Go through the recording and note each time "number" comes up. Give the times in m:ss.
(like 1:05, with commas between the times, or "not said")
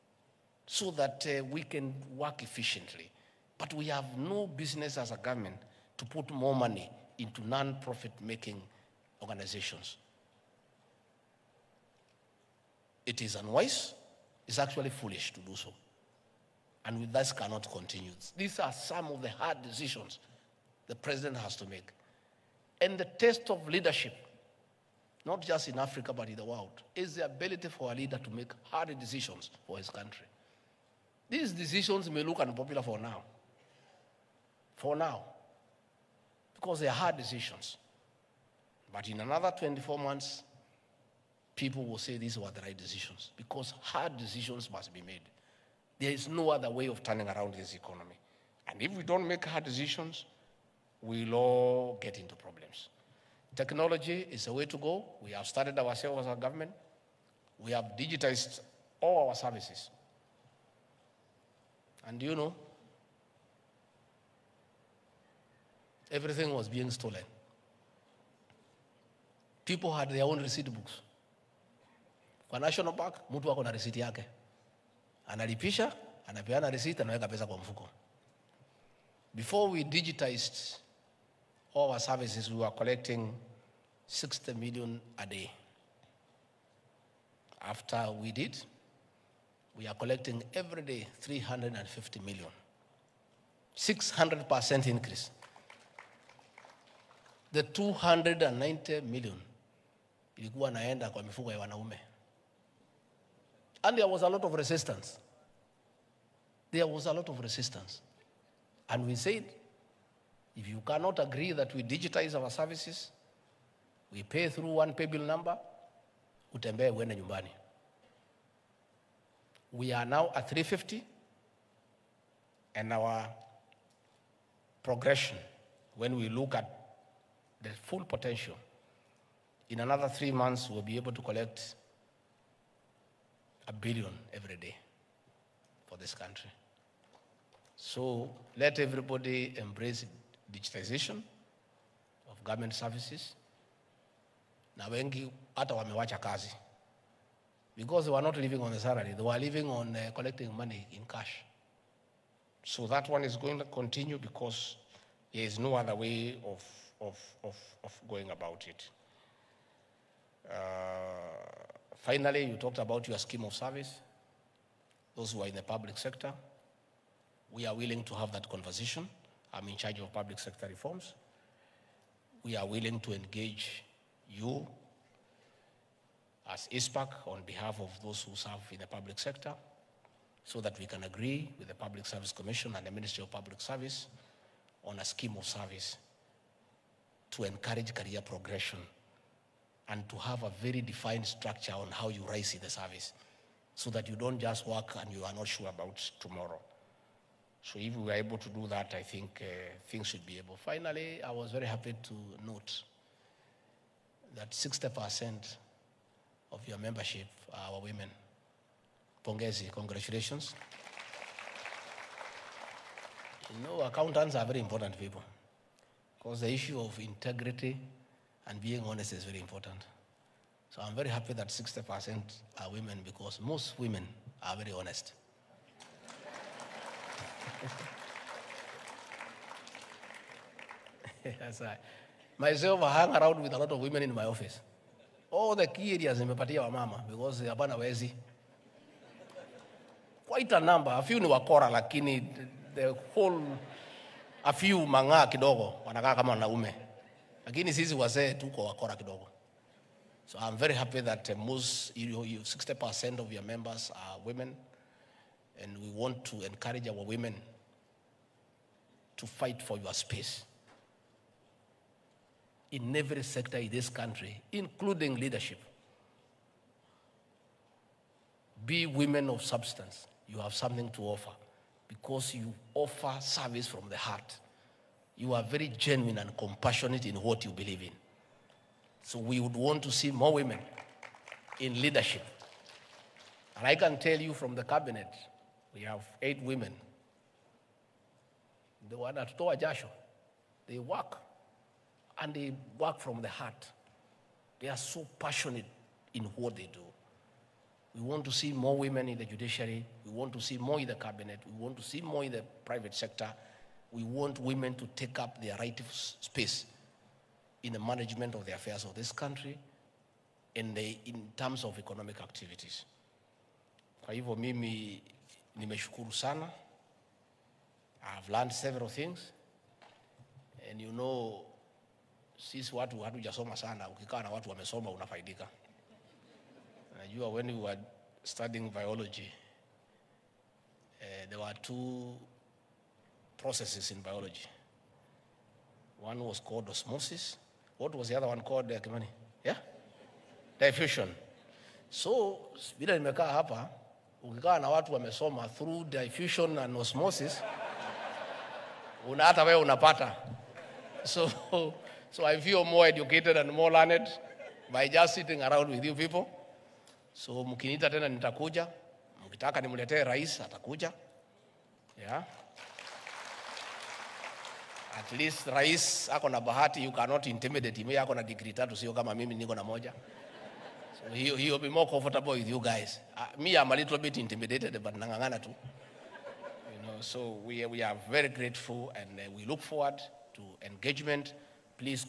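1:55, 4:00.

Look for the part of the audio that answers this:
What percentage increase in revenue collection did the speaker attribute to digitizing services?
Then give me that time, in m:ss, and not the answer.
1:33.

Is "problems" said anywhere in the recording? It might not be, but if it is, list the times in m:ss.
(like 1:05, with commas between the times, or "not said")
0:52.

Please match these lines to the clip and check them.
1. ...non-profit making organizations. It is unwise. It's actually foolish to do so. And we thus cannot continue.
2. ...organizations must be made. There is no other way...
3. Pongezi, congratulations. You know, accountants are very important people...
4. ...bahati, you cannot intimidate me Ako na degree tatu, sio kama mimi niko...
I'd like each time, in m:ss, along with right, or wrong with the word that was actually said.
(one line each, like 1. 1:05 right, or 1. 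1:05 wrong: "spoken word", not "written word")
1. 0:07 right
2. 0:44 wrong: "decisions", not "organizations"
3. 3:29 right
4. 6:06 right.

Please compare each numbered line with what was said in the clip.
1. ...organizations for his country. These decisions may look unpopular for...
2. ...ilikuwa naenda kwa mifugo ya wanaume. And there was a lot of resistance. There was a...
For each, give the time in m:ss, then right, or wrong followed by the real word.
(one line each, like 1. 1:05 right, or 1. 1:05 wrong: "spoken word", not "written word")
1. 0:28 wrong: "decisions", not "organizations"
2. 1:40 right.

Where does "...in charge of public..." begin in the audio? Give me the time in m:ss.
2:49.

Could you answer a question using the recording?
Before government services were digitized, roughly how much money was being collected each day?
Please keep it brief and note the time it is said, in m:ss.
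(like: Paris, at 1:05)
60 million, at 1:24.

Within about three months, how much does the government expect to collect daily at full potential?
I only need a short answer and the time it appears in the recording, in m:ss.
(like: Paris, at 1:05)
a billion, at 2:13.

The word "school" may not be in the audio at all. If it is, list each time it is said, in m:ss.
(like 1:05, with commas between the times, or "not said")
not said.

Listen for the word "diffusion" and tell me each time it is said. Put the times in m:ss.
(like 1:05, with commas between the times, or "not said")
5:40, 5:45.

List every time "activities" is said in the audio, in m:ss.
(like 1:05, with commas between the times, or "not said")
5:12.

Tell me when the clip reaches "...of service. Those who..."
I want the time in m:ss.
2:43.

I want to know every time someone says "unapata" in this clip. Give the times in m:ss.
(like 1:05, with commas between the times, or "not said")
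5:49.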